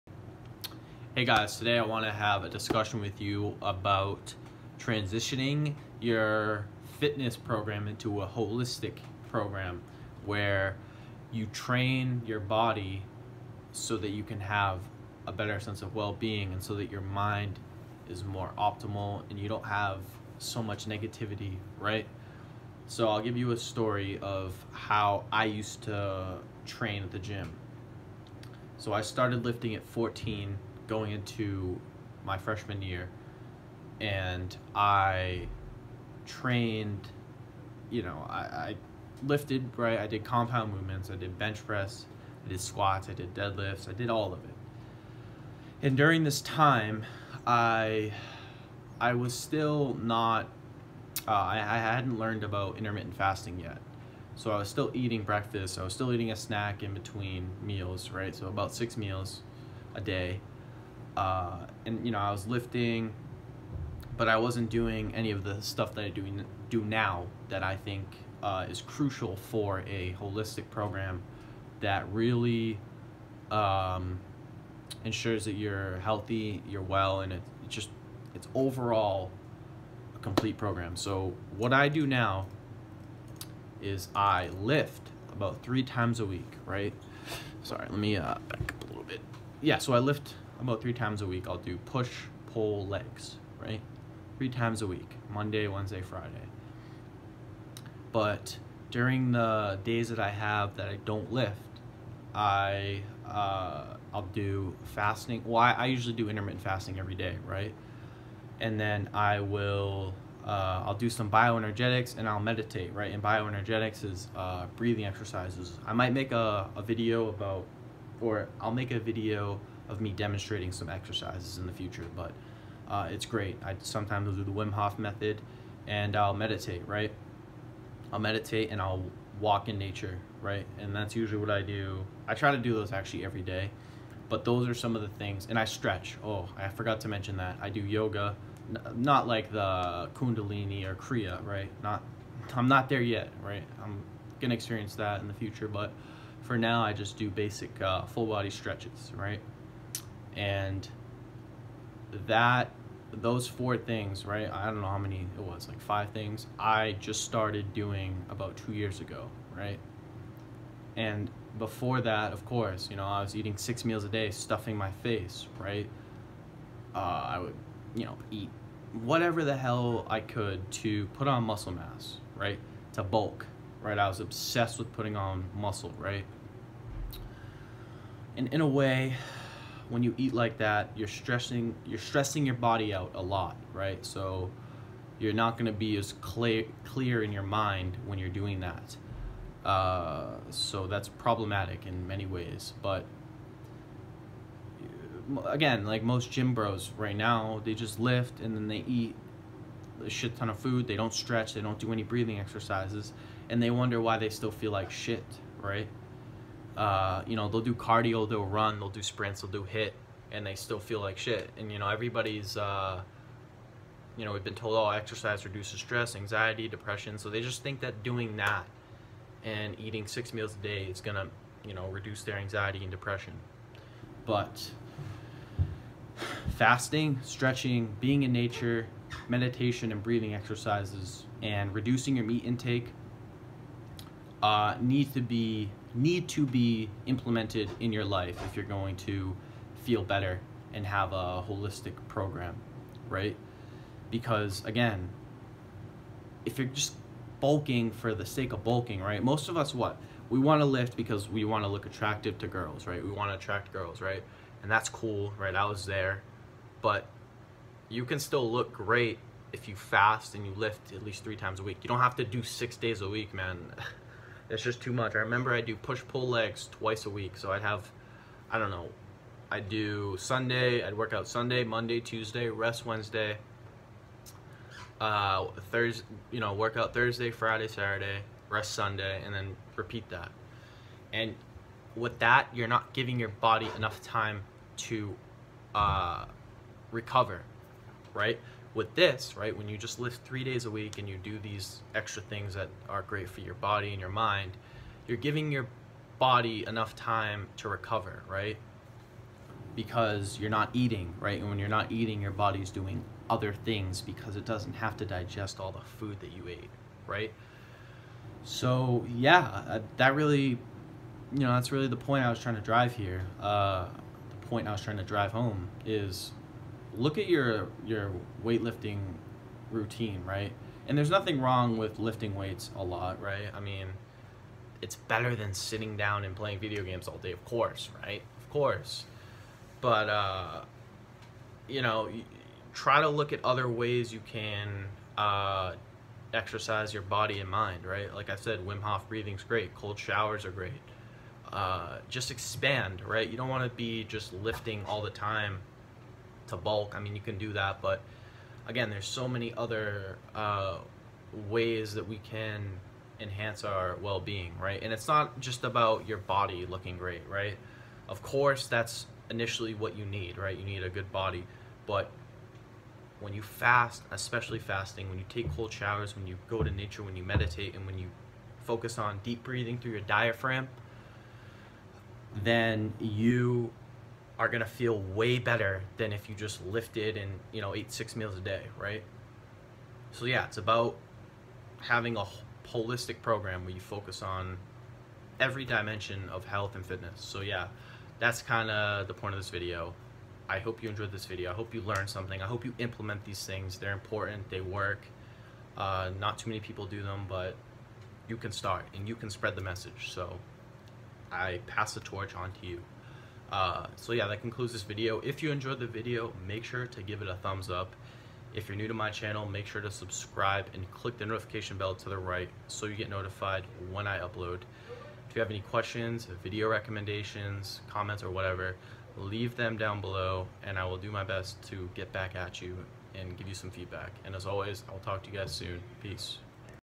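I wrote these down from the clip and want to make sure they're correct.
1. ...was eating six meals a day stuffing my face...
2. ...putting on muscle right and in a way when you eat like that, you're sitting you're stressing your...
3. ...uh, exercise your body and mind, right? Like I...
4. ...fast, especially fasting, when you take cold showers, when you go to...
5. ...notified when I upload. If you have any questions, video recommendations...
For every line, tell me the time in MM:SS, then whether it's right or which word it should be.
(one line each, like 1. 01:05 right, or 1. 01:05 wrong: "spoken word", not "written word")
1. 02:43 right
2. 02:54 wrong: "stressing", not "sitting"
3. 05:35 right
4. 06:03 right
5. 06:53 right.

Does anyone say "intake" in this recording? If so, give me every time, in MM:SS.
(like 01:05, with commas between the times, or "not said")
03:52.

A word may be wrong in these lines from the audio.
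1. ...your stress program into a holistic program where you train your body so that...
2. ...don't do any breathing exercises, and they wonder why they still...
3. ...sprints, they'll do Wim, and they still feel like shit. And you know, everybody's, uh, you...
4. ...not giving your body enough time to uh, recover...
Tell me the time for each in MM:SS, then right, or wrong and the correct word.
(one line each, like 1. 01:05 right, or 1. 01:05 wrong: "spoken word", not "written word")
1. 00:05 wrong: "fitness", not "stress"
2. 03:21 right
3. 03:29 wrong: "HIIT", not "Wim"
4. 04:42 right.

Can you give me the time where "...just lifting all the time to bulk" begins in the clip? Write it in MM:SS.
05:44.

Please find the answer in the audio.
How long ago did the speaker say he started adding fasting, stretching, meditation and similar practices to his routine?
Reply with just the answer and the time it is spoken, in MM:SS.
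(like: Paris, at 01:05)
2 years ago, at 02:38.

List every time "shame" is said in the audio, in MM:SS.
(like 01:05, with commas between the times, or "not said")
not said.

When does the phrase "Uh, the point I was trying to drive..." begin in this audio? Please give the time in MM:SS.
05:13.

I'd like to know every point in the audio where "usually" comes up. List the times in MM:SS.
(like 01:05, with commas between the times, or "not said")
01:45, 02:11.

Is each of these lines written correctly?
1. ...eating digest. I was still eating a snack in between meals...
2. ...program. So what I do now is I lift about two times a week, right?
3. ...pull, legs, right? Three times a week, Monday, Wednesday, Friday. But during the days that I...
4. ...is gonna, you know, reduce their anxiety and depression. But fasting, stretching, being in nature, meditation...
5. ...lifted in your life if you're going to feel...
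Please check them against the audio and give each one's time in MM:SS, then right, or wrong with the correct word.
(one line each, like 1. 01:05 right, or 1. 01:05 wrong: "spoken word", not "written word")
1. 00:54 wrong: "breakfast", not "digest"
2. 01:20 wrong: "three", not "two"
3. 01:32 right
4. 03:40 right
5. 03:57 wrong: "implemented", not "lifted".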